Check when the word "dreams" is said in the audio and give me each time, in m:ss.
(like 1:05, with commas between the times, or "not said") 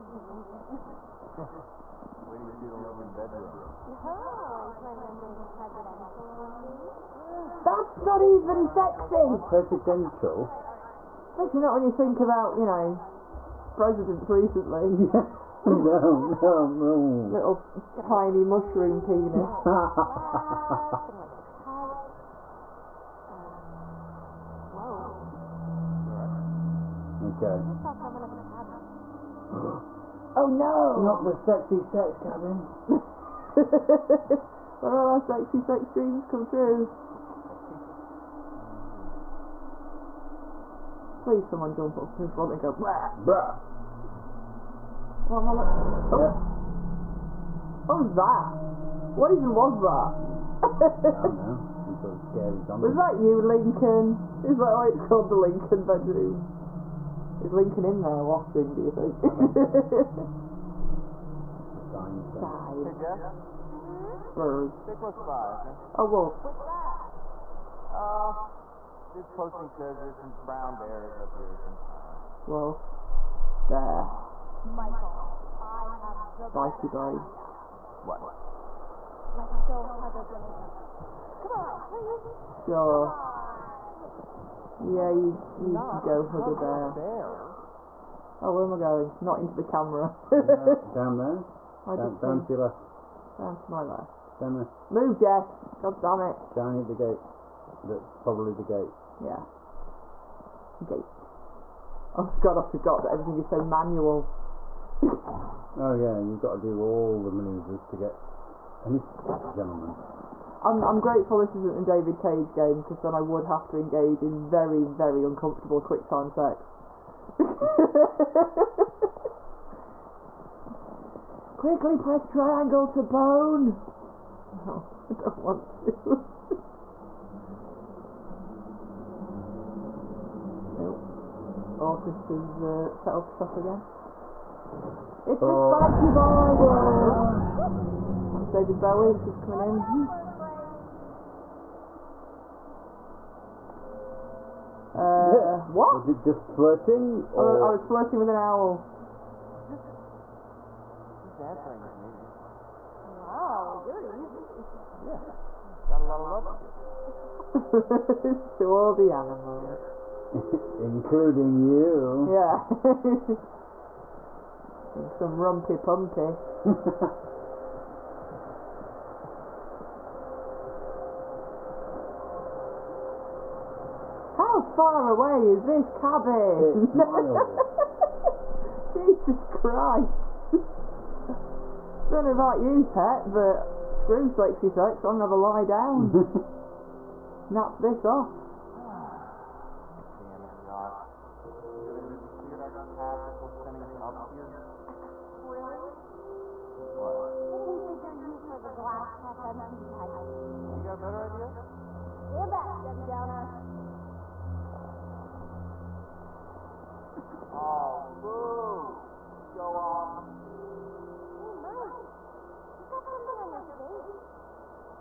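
0:35.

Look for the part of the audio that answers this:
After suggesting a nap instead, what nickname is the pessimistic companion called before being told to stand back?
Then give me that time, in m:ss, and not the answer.
3:22.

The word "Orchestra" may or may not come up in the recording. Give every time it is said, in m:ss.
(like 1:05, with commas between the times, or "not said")
2:11.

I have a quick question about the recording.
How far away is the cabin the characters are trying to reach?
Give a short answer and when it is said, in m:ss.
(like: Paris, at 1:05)
6 miles, at 2:56.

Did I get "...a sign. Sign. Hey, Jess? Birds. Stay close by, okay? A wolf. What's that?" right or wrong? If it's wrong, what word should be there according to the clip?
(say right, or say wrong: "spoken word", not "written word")
right.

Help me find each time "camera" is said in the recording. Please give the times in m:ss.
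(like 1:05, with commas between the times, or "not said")
1:29.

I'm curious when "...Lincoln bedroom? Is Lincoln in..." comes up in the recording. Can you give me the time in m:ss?
0:55.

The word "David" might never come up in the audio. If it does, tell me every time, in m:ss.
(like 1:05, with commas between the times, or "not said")
1:51, 2:18.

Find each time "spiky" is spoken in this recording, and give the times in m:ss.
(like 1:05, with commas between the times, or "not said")
1:16, 2:15.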